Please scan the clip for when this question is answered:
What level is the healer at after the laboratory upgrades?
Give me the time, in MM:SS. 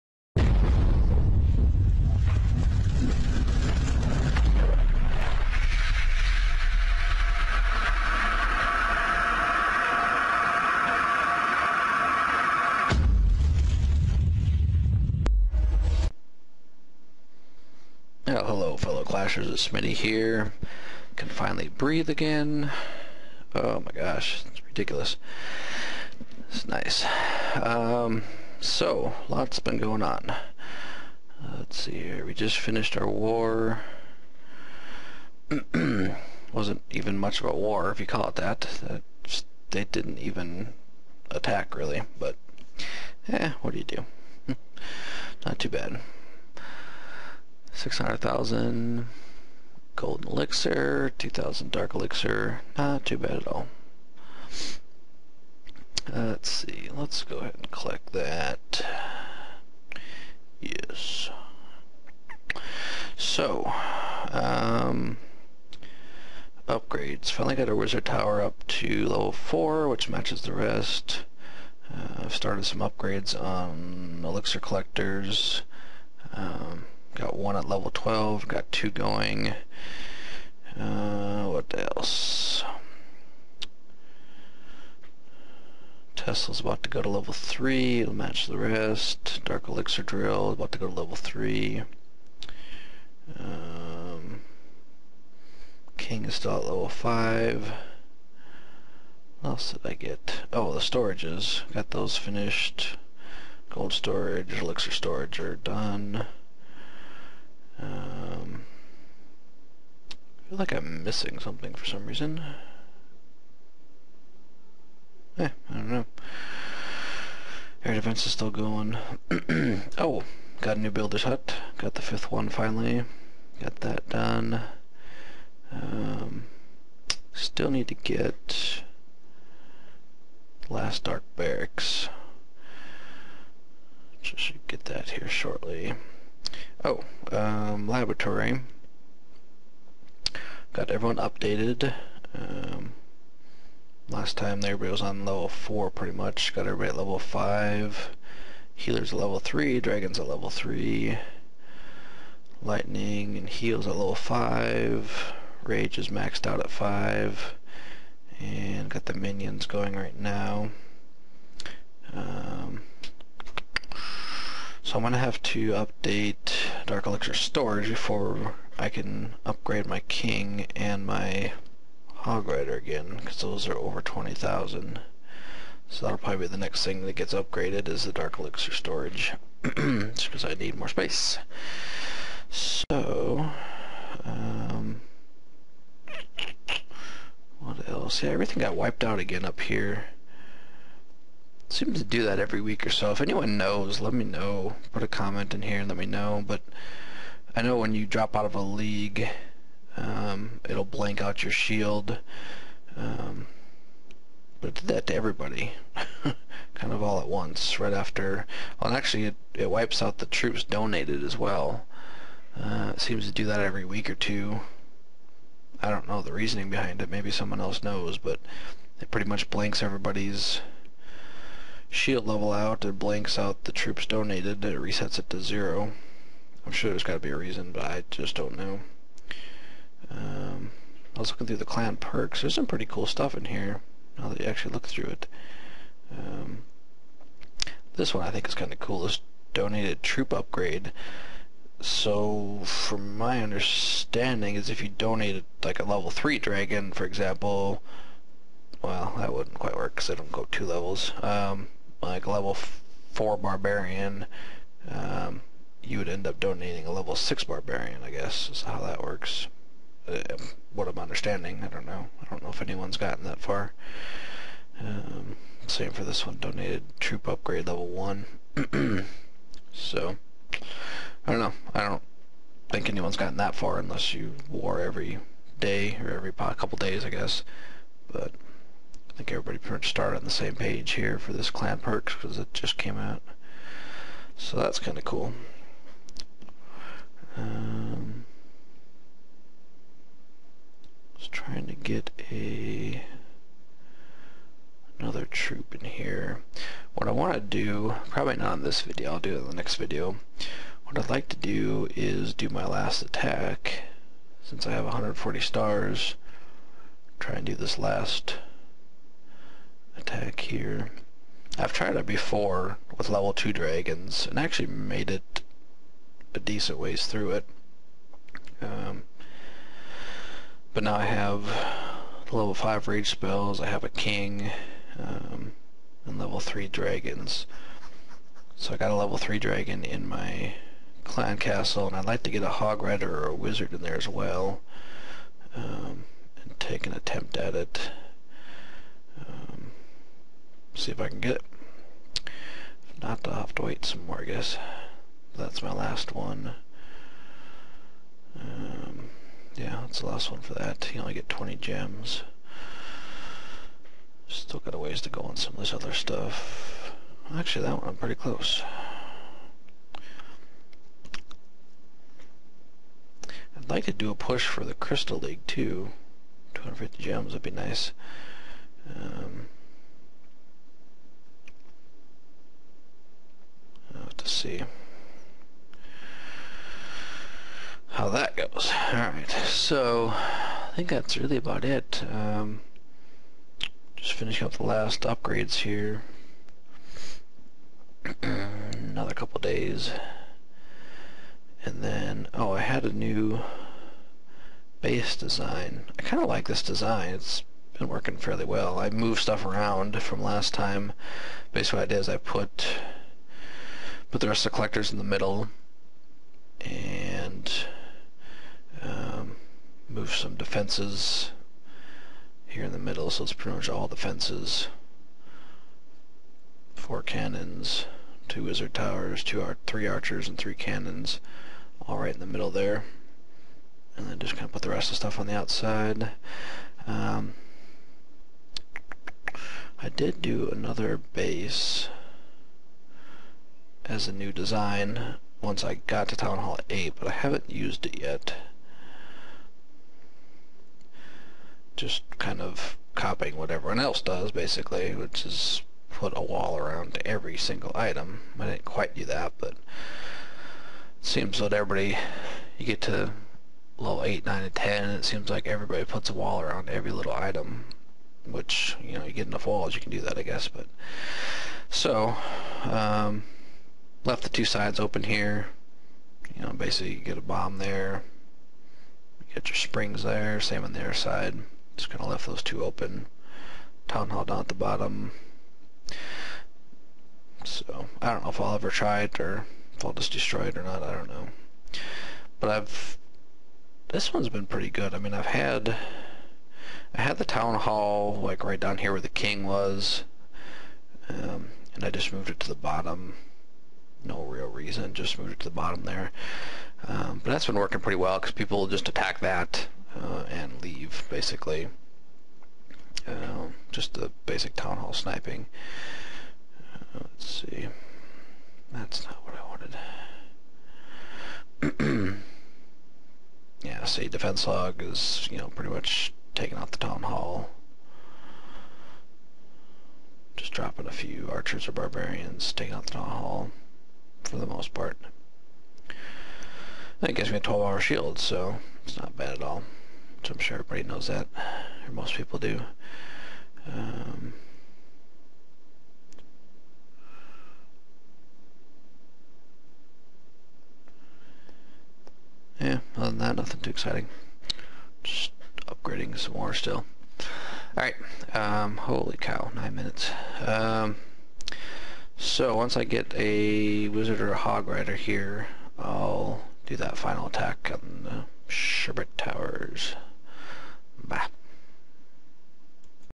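02:28.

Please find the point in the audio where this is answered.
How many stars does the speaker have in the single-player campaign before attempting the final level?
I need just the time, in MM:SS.
05:04.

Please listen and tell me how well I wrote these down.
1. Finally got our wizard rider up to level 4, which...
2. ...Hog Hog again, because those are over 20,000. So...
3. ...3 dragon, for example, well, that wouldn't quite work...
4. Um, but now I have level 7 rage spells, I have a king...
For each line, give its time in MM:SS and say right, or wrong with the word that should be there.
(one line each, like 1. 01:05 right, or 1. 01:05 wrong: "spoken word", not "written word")
1. 01:07 wrong: "tower", not "rider"
2. 02:52 wrong: "Rider", not "Hog"
3. 04:06 right
4. 05:18 wrong: "5", not "7".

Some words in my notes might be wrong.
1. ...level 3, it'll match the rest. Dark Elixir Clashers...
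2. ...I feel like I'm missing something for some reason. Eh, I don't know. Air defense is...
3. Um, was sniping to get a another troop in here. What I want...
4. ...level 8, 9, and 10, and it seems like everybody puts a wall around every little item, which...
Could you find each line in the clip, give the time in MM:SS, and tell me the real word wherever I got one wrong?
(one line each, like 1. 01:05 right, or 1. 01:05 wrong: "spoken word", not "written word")
1. 01:27 wrong: "Drill", not "Clashers"
2. 01:50 right
3. 04:47 wrong: "trying", not "sniping"
4. 07:33 right.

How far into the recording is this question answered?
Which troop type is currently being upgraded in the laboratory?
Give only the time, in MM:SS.
02:39.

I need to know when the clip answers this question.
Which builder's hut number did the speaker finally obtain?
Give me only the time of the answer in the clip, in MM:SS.
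02:02.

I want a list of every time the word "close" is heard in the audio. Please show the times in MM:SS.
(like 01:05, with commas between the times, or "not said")
05:58.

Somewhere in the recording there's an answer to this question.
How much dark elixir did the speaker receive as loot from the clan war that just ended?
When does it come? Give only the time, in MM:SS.
00:51.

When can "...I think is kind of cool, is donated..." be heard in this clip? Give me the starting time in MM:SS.
03:58.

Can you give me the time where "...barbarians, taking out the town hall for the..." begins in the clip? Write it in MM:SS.
08:41.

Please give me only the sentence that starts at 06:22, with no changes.
Um, just finishing up the last upgrades here.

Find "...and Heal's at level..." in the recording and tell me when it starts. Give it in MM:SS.
02:33.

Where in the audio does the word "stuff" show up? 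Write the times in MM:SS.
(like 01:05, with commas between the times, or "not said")
03:53, 05:55, 06:39, 07:04.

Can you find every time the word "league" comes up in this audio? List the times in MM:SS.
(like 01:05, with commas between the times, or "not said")
03:18, 06:05.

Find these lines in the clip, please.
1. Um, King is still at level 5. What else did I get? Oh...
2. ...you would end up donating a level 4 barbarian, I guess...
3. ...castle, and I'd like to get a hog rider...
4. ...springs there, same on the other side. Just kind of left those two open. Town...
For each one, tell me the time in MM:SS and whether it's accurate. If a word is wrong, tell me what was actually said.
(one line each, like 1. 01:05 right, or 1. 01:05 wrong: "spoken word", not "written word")
1. 01:33 right
2. 04:15 wrong: "6", not "4"
3. 05:31 right
4. 07:49 right.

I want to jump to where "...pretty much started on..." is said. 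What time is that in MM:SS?
04:39.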